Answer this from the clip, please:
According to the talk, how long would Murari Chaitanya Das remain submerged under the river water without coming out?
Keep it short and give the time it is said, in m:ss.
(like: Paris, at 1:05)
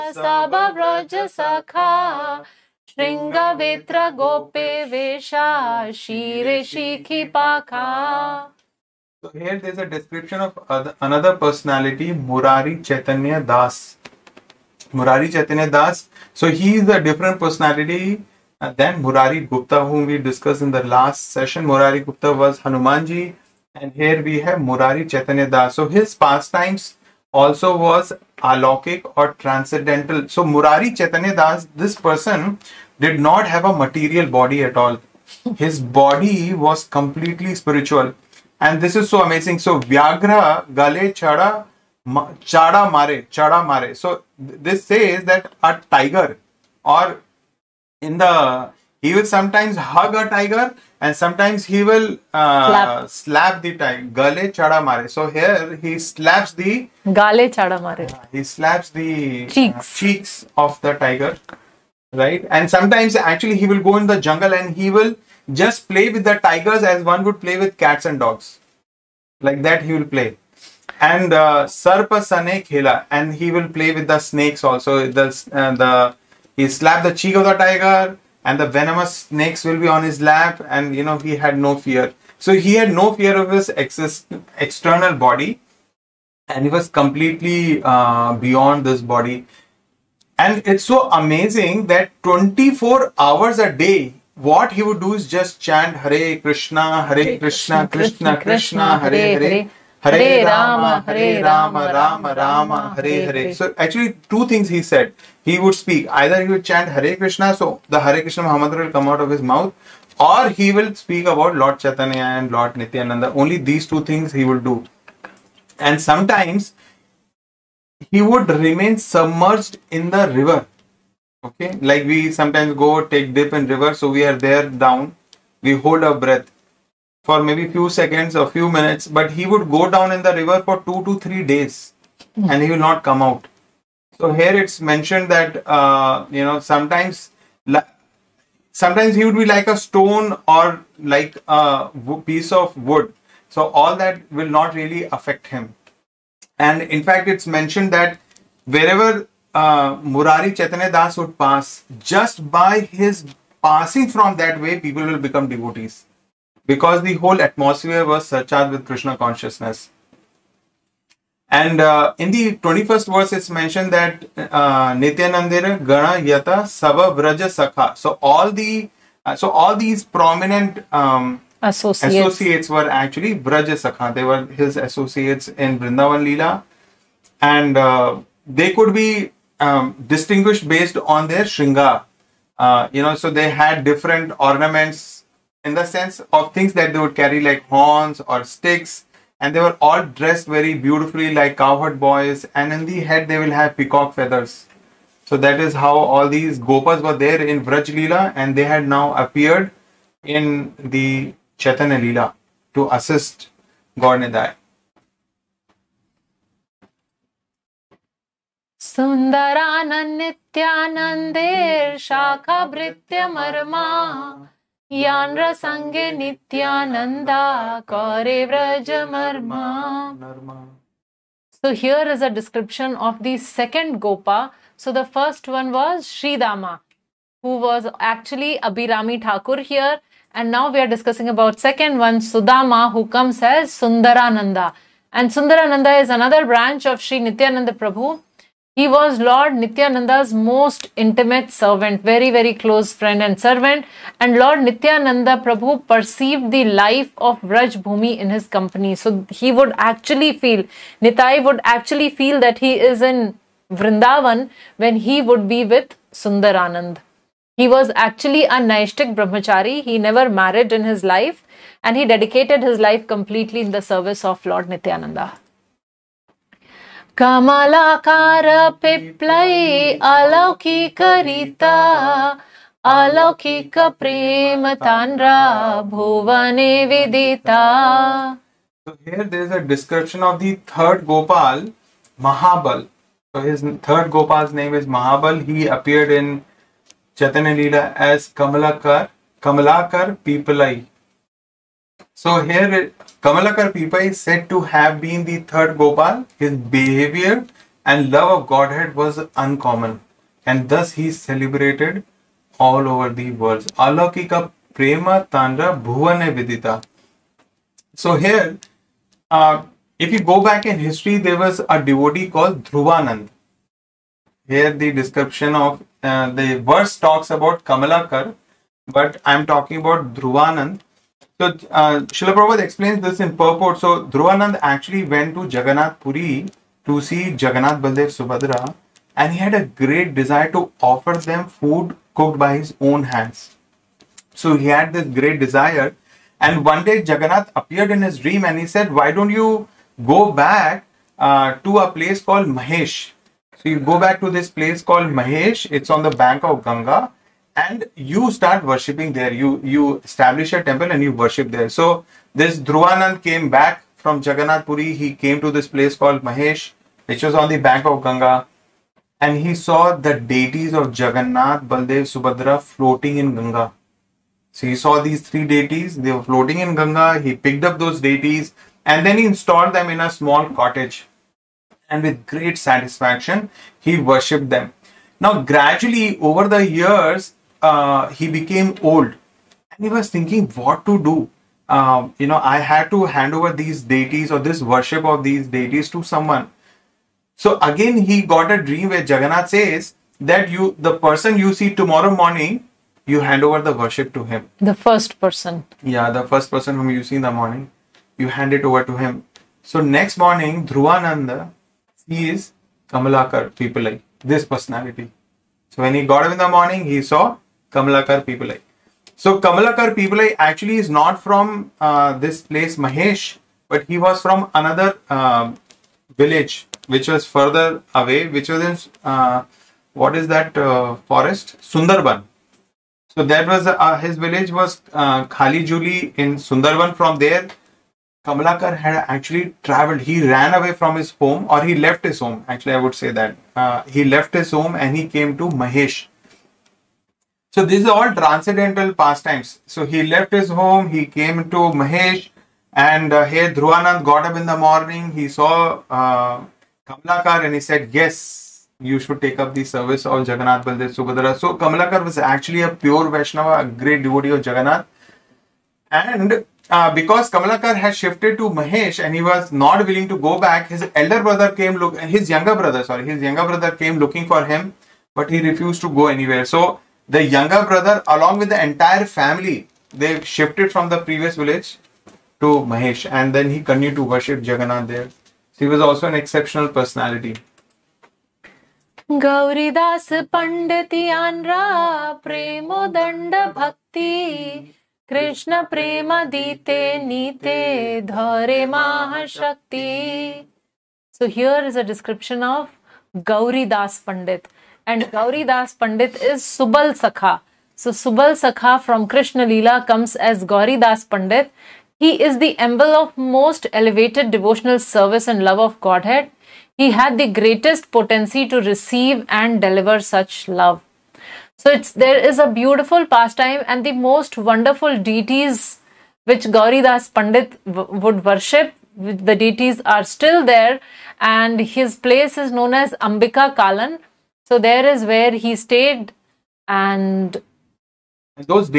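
2 to 3 days, at 2:10.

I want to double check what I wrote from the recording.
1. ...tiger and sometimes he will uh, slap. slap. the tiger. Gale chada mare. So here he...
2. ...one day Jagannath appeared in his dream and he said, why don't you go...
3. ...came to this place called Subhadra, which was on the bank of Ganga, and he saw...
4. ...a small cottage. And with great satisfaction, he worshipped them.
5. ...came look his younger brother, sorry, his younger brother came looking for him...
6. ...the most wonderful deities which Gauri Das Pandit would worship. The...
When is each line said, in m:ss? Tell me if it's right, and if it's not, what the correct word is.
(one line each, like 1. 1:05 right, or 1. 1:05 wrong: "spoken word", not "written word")
1. 0:50 right
2. 5:36 right
3. 5:55 wrong: "Mahesh", not "Subhadra"
4. 6:09 right
5. 7:41 right
6. 8:33 right.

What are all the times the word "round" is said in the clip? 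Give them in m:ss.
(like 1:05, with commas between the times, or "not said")
not said.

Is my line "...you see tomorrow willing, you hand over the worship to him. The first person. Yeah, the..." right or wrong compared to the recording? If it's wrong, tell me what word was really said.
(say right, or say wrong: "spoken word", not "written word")
wrong: "morning", not "willing".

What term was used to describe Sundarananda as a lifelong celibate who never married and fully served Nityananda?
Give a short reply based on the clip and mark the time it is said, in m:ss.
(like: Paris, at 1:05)
Naishtik Brahmachari, at 4:18.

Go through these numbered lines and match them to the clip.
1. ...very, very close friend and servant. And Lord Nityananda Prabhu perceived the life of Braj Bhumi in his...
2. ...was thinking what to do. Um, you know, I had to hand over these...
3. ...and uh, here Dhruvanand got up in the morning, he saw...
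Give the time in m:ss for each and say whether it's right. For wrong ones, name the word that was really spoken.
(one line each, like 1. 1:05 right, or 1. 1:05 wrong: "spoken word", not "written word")
1. 4:02 right
2. 6:19 right
3. 7:22 right.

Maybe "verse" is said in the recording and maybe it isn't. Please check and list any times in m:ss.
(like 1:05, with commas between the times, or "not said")
2:43, 5:16.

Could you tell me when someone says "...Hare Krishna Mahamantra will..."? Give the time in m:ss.
1:48.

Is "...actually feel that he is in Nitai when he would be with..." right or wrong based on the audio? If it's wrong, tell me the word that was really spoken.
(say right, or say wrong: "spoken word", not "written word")
wrong: "Vrindavan", not "Nitai".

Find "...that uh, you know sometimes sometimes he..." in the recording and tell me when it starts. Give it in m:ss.
2:15.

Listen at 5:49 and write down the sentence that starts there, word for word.
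You you establish a temple and you worship there.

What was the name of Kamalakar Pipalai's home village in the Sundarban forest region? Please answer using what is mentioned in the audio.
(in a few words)
Khali Juli.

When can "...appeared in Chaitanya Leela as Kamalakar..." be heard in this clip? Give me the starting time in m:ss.
4:45.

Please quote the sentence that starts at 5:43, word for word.
So you go back to this place called Mahesh.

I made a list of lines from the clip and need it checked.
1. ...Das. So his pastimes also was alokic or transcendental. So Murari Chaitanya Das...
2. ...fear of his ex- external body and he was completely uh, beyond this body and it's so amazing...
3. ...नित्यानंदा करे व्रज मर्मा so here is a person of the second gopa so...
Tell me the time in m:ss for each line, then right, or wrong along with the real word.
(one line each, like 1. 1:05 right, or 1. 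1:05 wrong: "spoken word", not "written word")
1. 0:25 right
2. 1:23 right
3. 3:34 wrong: "description", not "person".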